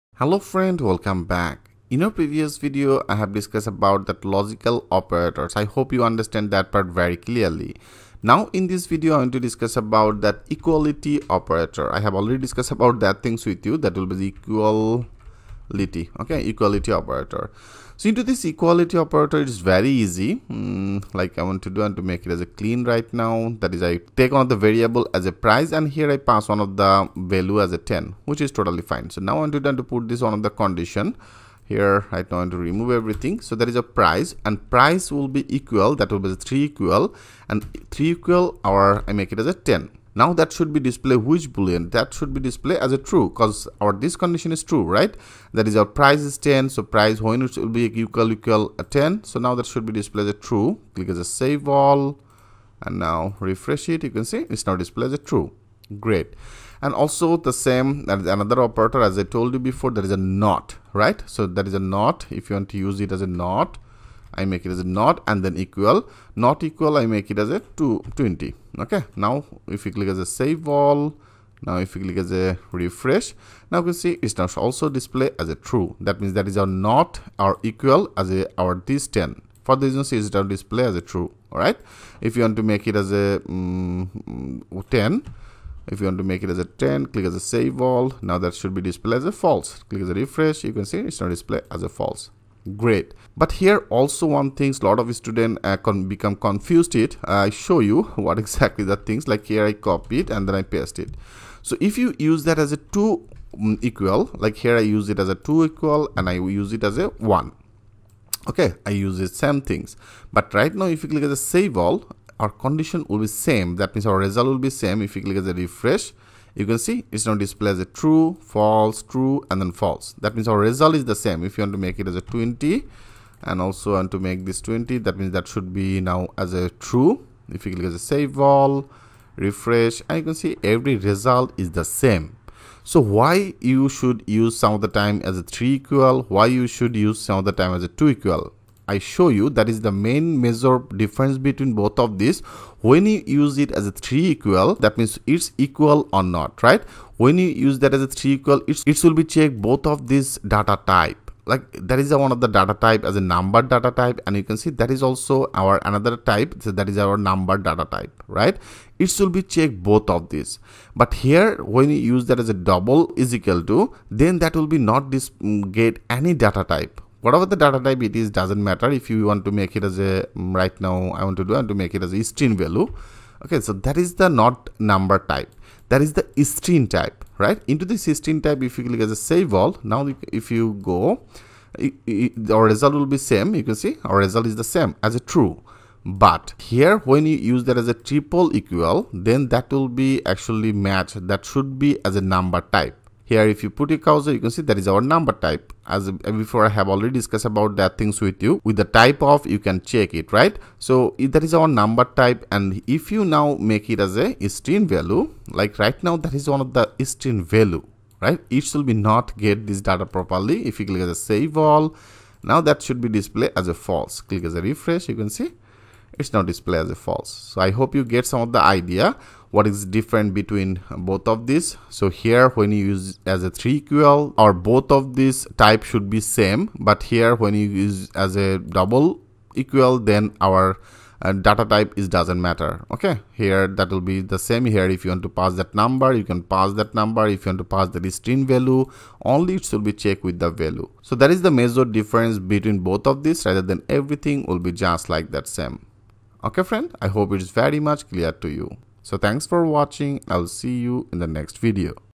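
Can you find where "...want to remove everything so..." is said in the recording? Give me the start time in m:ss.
0:32.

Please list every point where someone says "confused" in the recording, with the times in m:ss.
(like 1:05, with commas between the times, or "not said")
1:36.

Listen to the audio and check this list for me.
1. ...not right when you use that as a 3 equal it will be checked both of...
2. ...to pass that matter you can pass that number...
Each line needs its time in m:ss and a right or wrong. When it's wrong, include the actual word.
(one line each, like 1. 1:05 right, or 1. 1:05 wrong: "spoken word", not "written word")
1. 2:26 right
2. 3:55 wrong: "number", not "matter".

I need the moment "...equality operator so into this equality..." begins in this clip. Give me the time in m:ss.
0:16.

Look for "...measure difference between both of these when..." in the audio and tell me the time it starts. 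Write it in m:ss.
2:20.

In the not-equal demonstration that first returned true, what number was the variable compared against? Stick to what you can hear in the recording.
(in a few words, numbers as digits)
220.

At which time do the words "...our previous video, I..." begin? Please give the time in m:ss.
0:02.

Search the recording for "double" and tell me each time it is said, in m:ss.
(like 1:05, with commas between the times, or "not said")
2:42, 3:48.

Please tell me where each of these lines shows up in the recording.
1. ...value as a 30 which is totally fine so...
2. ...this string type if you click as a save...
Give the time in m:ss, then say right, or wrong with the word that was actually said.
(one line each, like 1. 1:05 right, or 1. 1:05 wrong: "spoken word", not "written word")
1. 0:27 wrong: "10", not "30"
2. 2:57 right.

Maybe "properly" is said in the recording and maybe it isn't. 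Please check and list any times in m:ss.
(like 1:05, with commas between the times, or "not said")
3:30.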